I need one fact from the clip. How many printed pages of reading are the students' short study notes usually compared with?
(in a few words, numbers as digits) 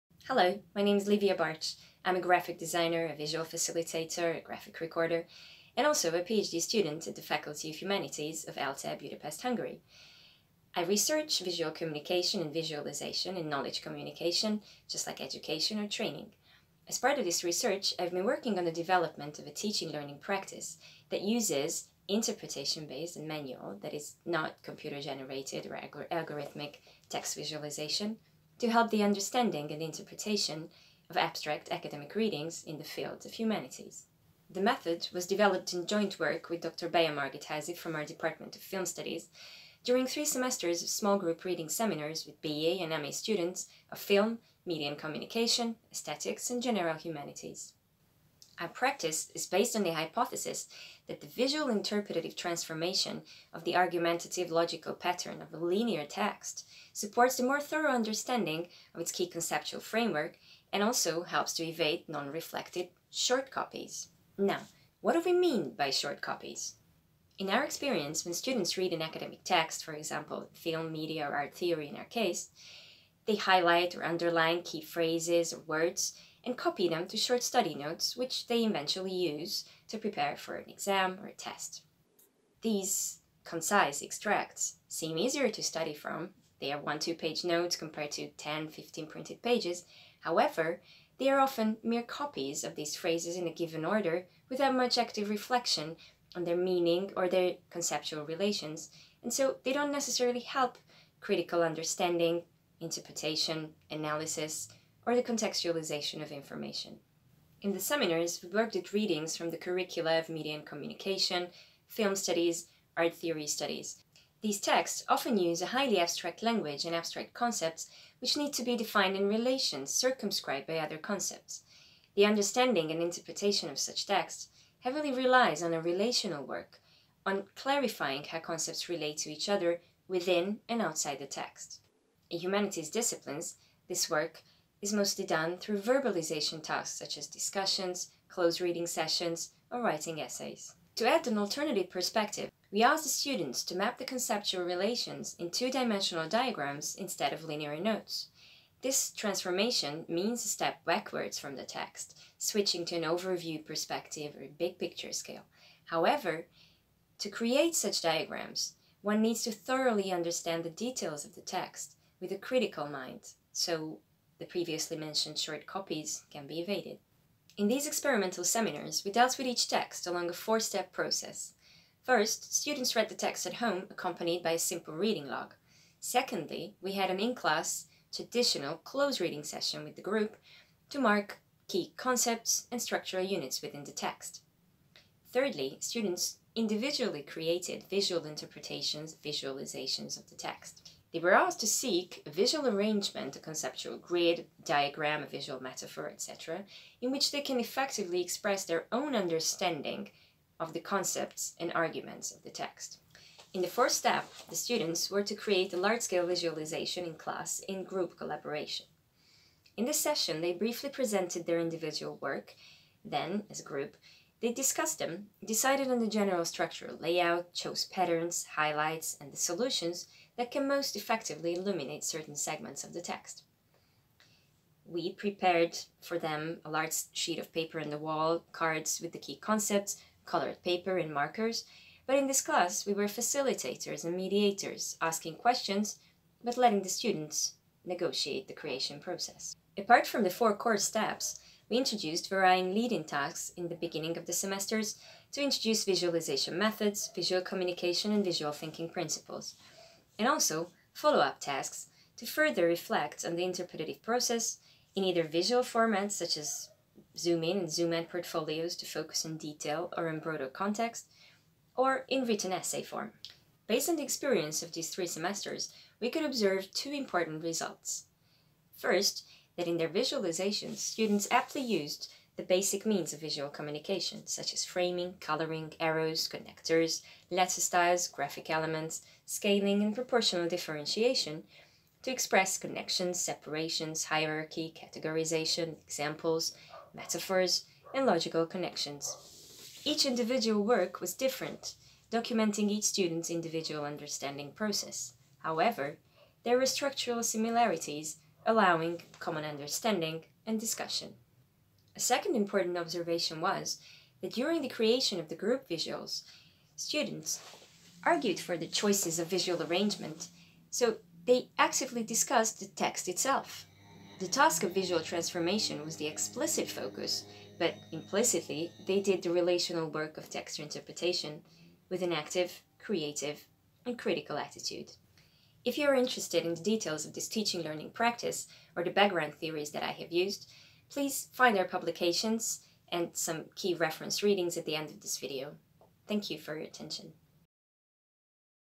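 10 to 15.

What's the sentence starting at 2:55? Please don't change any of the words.
Secondly, we had an in-class, traditional close reading session with the group to mark key concepts and structural units within the text.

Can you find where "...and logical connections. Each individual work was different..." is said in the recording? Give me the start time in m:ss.
4:47.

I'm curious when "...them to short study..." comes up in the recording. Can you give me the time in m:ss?
1:16.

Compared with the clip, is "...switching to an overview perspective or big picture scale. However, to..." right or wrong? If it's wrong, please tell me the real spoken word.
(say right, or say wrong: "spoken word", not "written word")
right.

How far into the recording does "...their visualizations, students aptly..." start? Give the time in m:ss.
4:29.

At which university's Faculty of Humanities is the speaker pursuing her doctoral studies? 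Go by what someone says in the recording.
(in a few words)
ELTE Budapest.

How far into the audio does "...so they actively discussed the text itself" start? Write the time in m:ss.
5:10.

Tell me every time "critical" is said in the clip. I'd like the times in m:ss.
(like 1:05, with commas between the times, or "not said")
1:41, 2:42, 5:23.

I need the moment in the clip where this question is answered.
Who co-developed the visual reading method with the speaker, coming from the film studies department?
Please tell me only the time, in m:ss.
0:36.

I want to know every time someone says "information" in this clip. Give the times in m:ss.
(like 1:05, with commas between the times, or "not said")
1:46.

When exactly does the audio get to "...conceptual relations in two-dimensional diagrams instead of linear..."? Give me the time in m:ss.
2:24.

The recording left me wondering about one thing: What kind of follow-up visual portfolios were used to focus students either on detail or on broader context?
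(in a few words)
zoom in and zoom out portfolios.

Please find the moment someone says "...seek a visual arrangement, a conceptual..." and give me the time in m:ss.
3:11.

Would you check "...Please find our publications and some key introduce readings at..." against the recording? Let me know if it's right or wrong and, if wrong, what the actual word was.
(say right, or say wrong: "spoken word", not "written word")
wrong: "reference", not "introduce".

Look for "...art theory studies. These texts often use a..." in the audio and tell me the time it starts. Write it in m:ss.
1:52.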